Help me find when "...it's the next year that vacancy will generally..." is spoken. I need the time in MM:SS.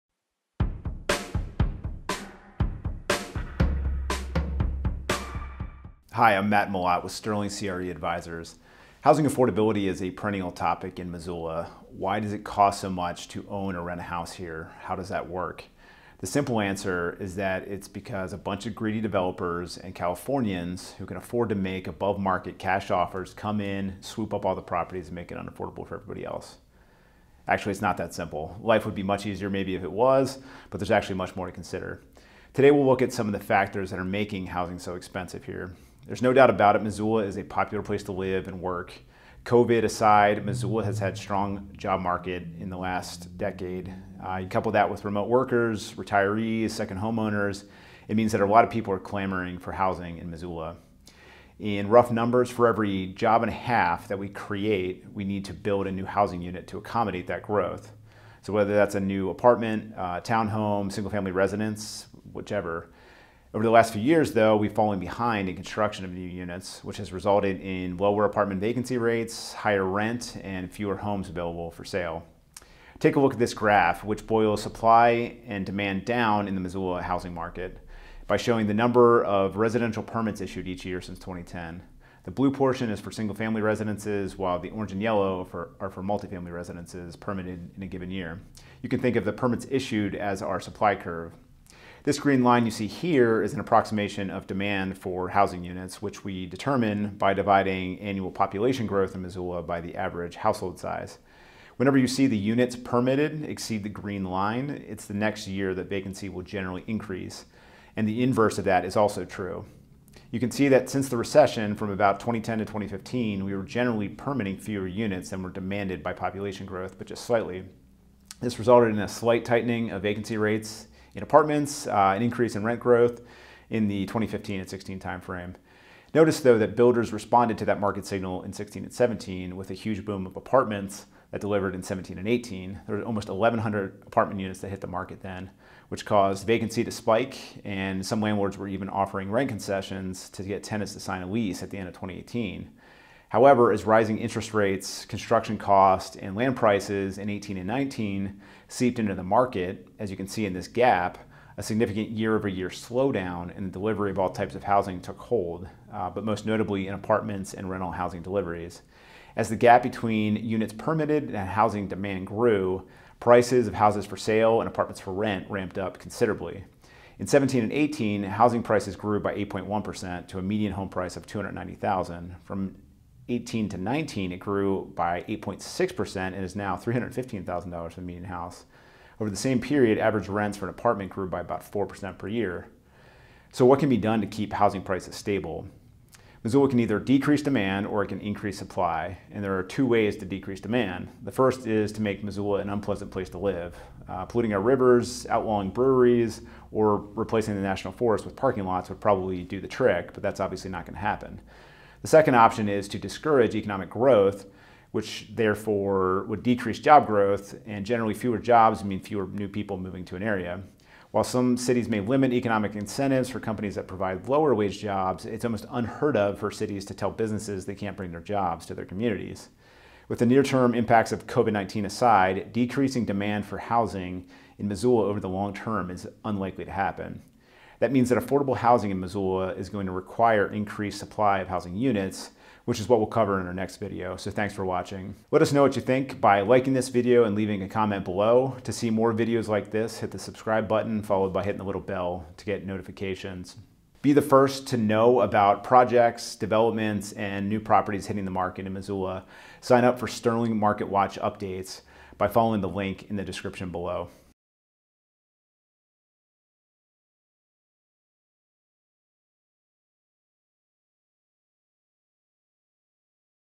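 01:44.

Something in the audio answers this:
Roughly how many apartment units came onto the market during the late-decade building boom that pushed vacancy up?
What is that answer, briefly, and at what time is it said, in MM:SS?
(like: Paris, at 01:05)
1,100, at 02:13.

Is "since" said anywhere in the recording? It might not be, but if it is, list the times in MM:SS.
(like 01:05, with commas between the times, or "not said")
01:21, 01:50.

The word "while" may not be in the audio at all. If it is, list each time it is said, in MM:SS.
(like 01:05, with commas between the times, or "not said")
01:24, 03:31.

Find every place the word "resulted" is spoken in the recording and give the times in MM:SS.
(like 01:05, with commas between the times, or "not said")
01:07, 01:58.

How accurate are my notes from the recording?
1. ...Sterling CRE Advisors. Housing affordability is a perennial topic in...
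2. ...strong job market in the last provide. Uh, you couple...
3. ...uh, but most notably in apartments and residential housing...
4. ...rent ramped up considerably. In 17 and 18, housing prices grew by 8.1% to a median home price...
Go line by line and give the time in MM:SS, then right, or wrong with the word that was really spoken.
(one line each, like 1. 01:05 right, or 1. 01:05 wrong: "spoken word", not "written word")
1. 00:07 right
2. 00:41 wrong: "decade", not "provide"
3. 02:35 wrong: "rental", not "residential"
4. 02:45 right.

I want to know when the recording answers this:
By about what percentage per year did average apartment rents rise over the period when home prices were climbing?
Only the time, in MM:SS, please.
03:01.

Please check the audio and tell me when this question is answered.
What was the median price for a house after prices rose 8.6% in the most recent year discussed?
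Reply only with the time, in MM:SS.
02:56.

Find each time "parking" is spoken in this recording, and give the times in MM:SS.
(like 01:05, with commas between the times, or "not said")
03:18.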